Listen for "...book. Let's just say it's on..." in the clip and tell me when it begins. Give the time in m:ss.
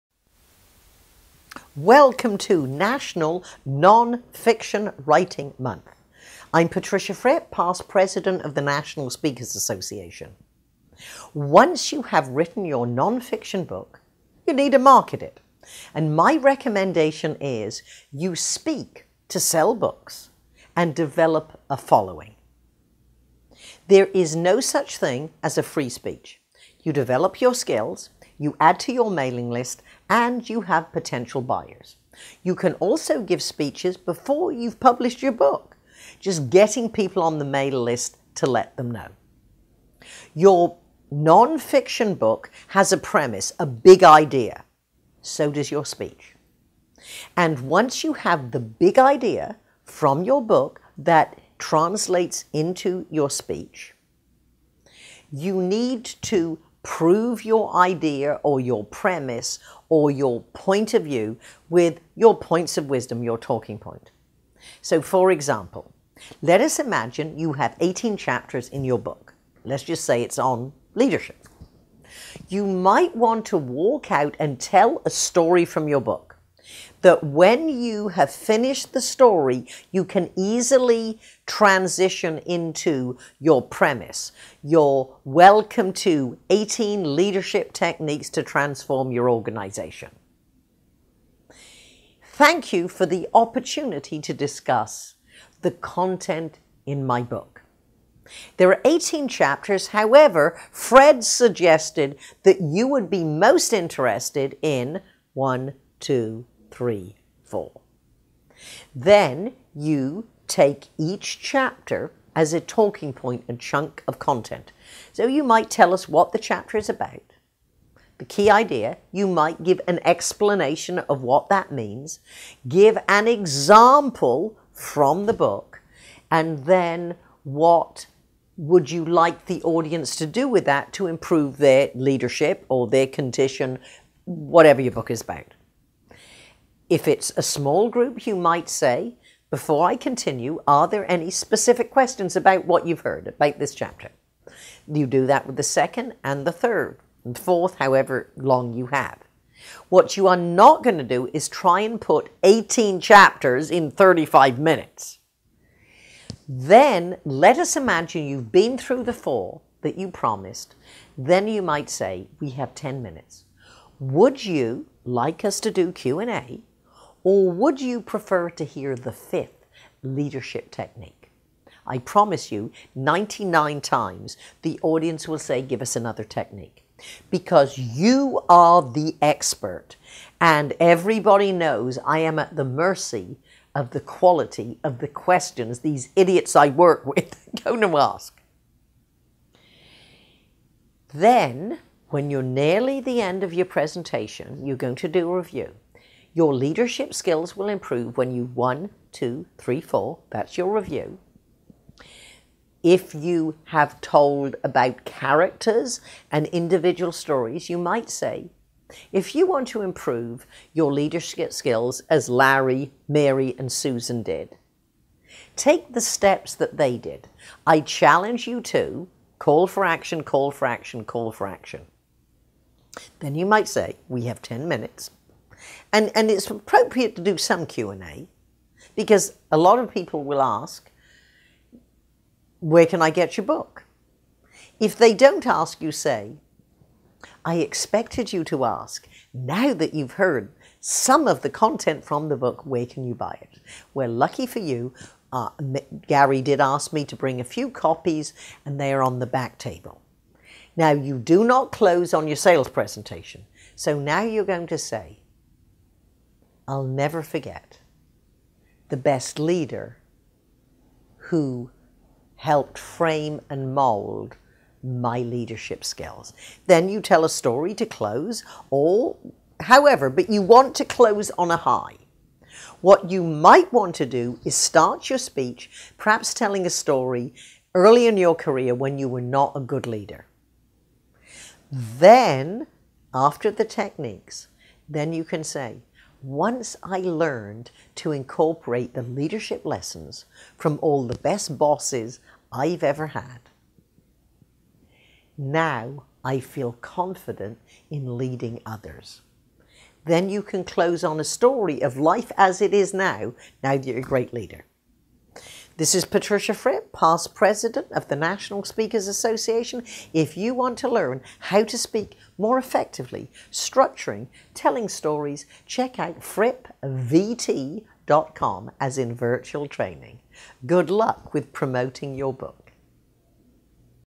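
1:08.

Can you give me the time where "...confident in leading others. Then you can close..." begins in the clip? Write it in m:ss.
4:56.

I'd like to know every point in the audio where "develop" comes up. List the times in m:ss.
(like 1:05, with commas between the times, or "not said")
0:20, 0:26.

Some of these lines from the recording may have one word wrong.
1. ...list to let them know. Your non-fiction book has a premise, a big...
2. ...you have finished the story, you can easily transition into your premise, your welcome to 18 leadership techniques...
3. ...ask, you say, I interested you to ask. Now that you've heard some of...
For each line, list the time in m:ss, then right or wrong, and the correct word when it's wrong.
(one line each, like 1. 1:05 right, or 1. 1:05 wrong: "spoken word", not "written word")
1. 0:37 right
2. 1:17 right
3. 3:55 wrong: "expected", not "interested".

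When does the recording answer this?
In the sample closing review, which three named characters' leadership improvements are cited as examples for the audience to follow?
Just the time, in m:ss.
3:32.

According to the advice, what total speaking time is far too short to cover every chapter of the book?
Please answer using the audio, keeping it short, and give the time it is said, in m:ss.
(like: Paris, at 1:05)
35 minutes, at 2:33.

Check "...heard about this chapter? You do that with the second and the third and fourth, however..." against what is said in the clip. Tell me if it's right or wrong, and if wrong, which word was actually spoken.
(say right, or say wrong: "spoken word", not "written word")
right.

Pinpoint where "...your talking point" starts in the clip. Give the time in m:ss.
1:03.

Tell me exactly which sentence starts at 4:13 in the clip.
So now you're going to say, I'll never forget the best leader who helped frame and mold my leadership skills.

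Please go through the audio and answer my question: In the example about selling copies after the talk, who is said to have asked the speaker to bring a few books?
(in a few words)
Gary.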